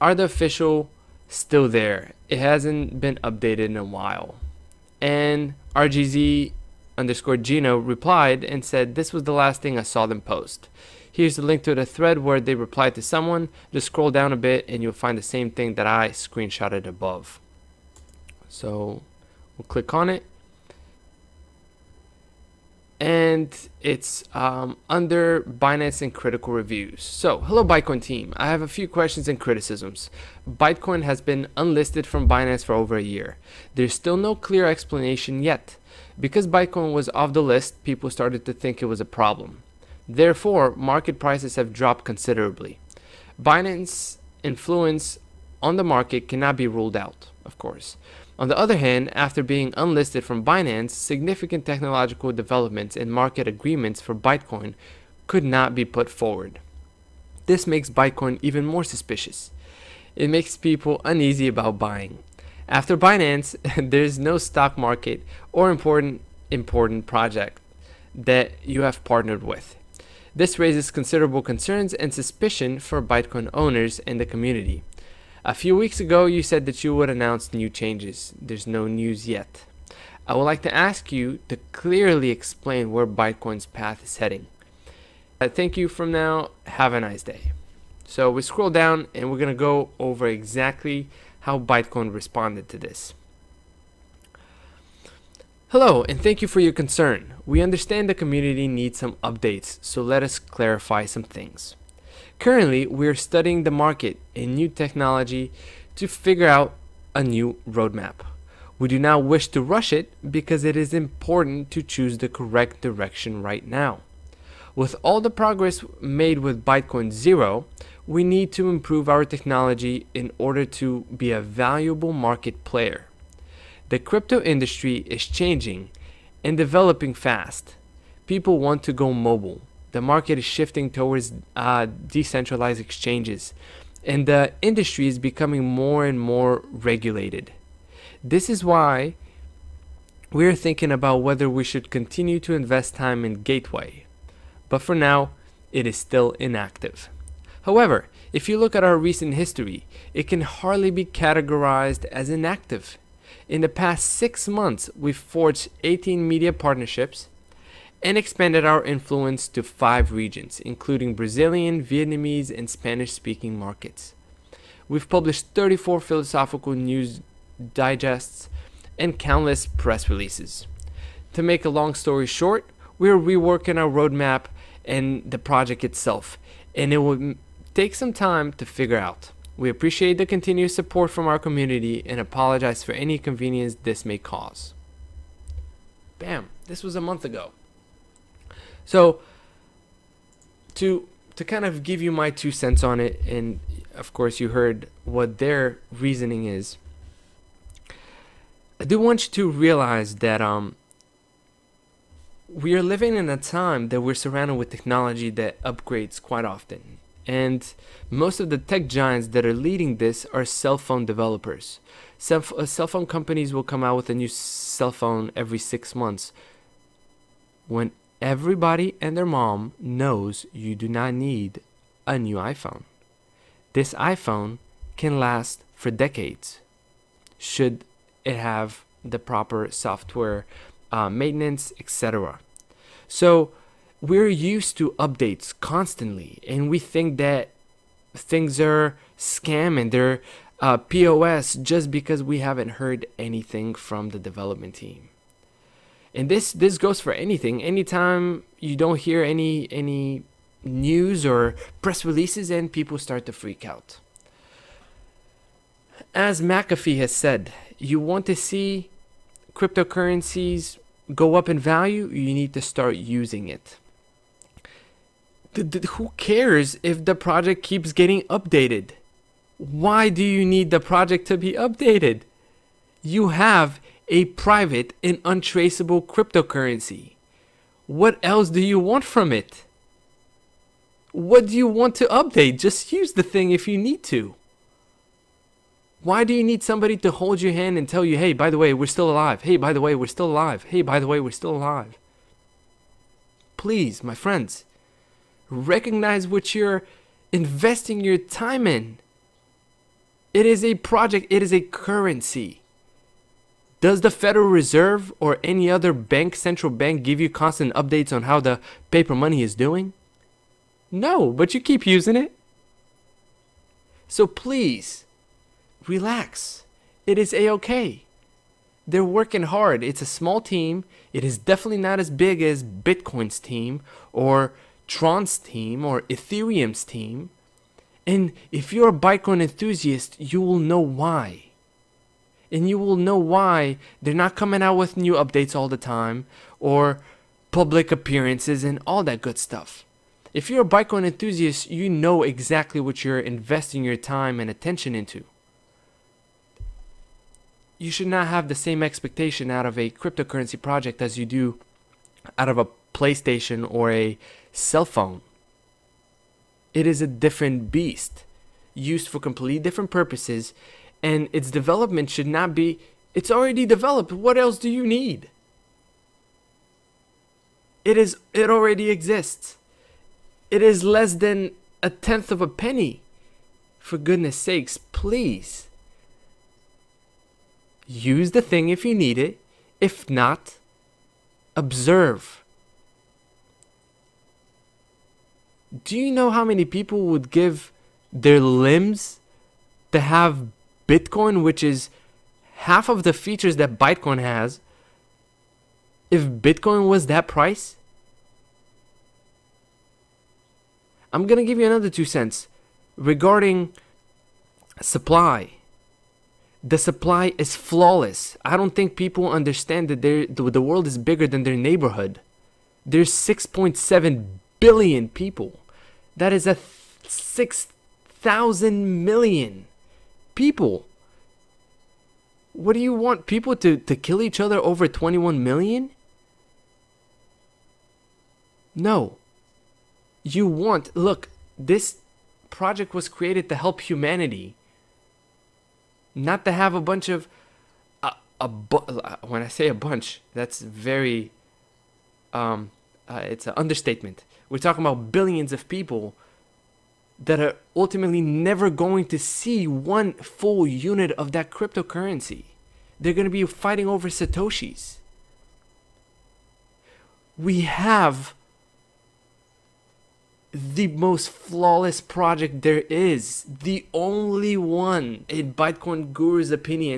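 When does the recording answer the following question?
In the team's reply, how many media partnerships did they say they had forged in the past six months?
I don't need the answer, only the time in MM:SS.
02:35.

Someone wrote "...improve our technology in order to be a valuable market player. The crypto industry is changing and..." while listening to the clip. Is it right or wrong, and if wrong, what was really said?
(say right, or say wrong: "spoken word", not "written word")
right.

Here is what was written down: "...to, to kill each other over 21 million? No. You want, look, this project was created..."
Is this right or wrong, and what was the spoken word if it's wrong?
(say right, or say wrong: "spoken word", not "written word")
right.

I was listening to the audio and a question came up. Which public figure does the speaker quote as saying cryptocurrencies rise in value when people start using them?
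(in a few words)
McAfee.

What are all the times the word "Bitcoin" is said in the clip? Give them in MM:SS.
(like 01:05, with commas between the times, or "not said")
05:22, 06:30, 06:36.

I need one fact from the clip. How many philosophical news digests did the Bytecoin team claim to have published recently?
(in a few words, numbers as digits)
34.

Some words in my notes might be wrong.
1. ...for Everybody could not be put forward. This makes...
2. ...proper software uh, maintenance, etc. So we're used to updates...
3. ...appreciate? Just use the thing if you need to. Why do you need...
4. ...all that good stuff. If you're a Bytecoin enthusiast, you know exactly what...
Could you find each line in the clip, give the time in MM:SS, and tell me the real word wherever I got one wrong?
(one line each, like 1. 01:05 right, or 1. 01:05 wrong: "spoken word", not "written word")
1. 00:54 wrong: "Bytecoin", not "Everybody"
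2. 03:49 right
3. 04:42 wrong: "update", not "appreciate"
4. 05:38 right.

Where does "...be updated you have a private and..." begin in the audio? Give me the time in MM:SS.
04:31.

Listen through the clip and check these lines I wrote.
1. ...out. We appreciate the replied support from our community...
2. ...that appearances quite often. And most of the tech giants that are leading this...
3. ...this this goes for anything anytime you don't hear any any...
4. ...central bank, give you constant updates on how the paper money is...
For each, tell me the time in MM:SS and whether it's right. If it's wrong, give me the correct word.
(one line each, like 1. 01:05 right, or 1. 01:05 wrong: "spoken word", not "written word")
1. 02:58 wrong: "continued", not "replied"
2. 03:25 wrong: "upgrades", not "appearances"
3. 04:06 right
4. 05:06 right.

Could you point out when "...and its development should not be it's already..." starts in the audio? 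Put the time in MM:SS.
06:01.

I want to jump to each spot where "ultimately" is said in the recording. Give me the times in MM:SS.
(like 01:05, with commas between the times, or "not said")
07:27.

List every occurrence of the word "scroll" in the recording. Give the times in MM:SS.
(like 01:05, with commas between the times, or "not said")
00:13, 01:28.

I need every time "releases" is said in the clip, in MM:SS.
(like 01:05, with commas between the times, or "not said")
02:50, 04:12.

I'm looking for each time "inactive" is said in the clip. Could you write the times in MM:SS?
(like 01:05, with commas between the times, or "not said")
02:26, 02:32.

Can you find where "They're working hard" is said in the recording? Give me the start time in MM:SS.
05:18.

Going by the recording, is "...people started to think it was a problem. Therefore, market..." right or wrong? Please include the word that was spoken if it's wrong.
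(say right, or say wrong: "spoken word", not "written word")
right.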